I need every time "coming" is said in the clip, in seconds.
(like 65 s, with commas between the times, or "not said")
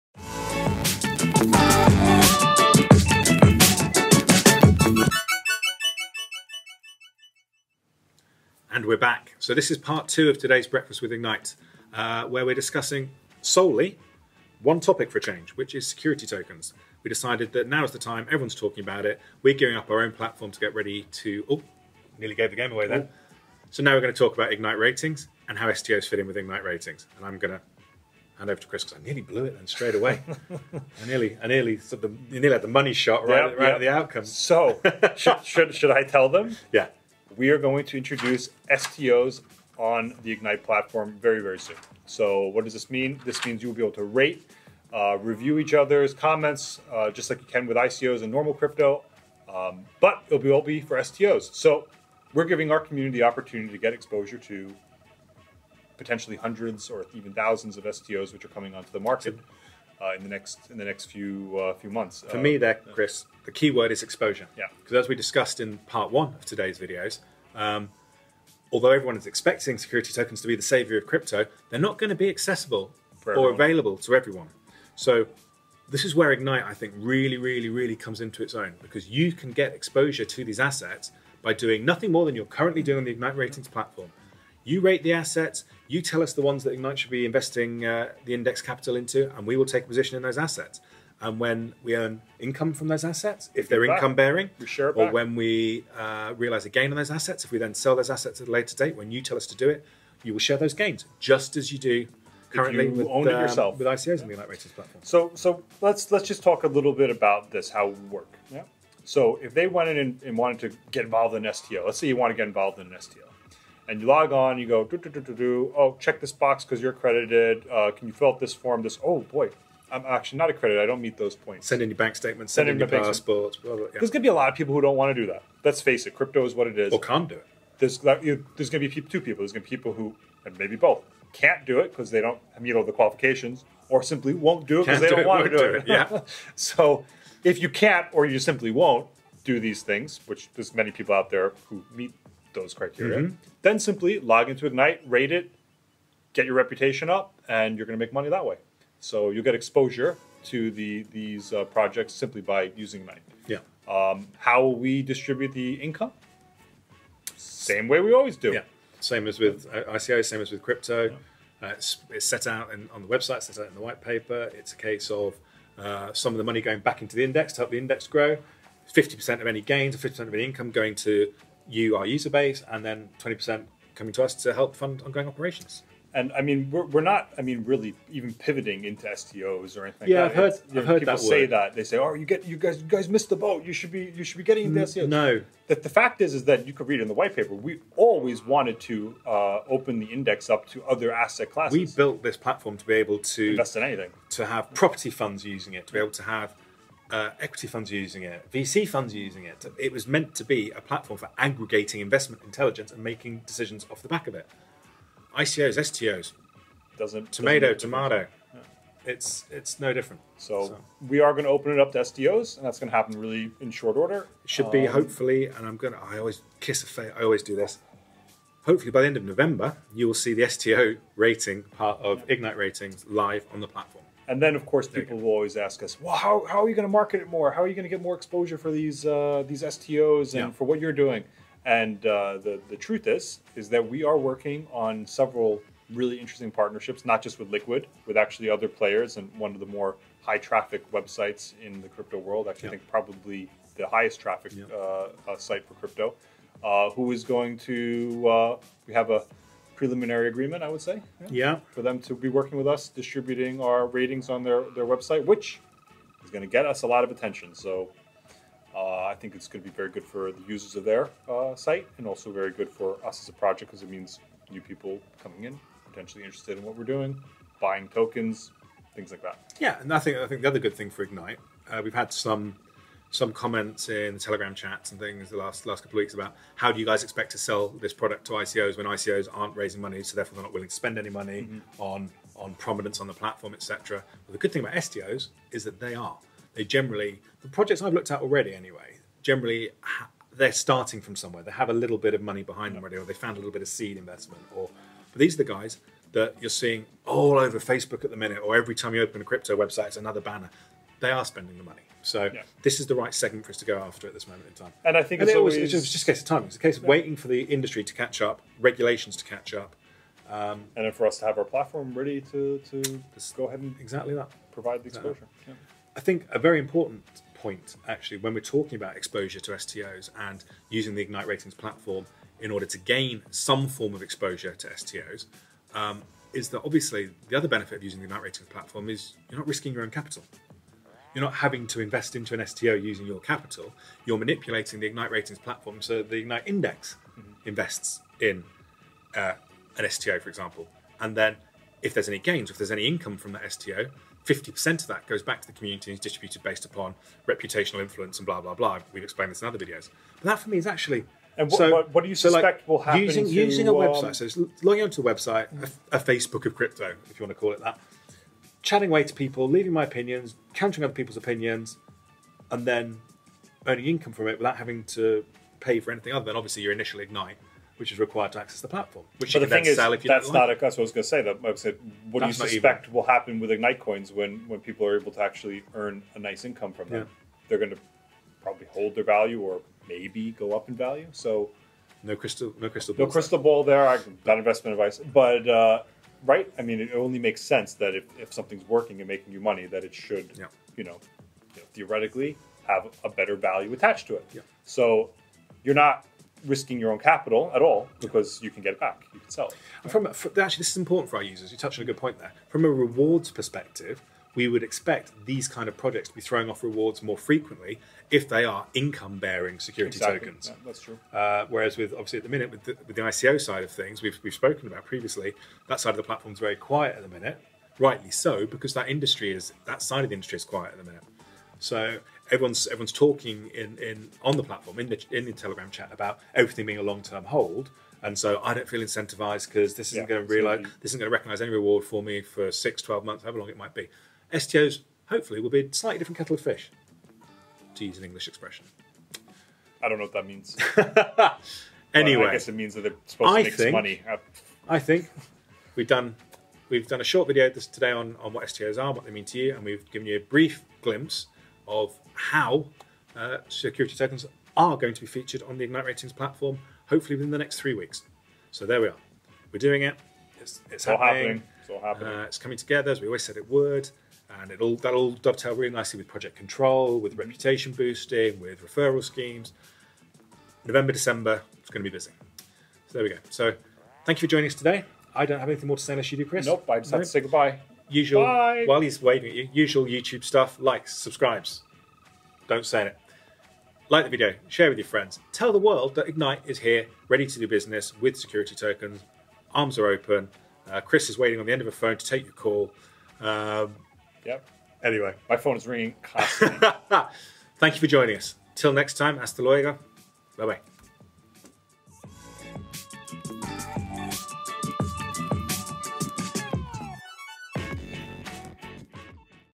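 58 s, 173 s, 265 s, 462 s.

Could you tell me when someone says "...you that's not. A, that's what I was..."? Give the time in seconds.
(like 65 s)
370 s.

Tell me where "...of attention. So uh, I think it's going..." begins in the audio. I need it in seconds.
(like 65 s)
257 s.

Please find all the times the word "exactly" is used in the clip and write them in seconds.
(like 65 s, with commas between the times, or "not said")
313 s, 409 s.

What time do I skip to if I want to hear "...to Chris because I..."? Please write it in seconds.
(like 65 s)
28 s.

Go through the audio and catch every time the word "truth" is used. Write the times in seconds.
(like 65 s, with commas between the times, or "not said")
232 s.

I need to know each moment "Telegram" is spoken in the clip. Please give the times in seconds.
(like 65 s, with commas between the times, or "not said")
274 s, 425 s.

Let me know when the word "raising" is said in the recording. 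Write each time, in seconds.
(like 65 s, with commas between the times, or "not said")
279 s.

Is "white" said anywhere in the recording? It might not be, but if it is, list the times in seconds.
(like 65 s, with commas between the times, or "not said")
163 s, 187 s.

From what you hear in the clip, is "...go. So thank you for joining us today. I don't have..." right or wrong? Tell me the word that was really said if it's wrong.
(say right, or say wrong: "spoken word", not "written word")
right.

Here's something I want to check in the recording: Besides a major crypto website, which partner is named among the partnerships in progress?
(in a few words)
Liquid.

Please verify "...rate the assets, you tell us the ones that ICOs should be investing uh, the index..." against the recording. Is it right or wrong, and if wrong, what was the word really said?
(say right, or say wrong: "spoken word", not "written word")
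wrong: "Ignite", not "ICOs".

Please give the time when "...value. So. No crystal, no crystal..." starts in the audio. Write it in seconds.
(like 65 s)
380 s.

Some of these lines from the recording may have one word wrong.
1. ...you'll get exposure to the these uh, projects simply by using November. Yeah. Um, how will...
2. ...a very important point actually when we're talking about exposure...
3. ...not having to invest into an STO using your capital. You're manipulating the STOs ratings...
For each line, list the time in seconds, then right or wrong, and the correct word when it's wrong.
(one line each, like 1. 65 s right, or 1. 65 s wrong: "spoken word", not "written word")
1. 149 s wrong: "Ignite", not "November"
2. 316 s right
3. 331 s wrong: "Ignite", not "STOs".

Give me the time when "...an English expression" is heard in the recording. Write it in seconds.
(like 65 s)
437 s.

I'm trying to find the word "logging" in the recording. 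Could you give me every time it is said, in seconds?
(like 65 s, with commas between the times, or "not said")
354 s.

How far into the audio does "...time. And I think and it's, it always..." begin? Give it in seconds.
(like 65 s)
304 s.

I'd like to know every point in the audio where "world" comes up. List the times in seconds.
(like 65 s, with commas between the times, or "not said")
242 s, 485 s.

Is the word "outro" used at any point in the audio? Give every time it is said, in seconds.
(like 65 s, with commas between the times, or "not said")
not said.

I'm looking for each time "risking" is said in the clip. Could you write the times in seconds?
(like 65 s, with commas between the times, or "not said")
329 s, 396 s.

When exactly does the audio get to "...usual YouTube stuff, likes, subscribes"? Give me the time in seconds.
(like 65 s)
479 s.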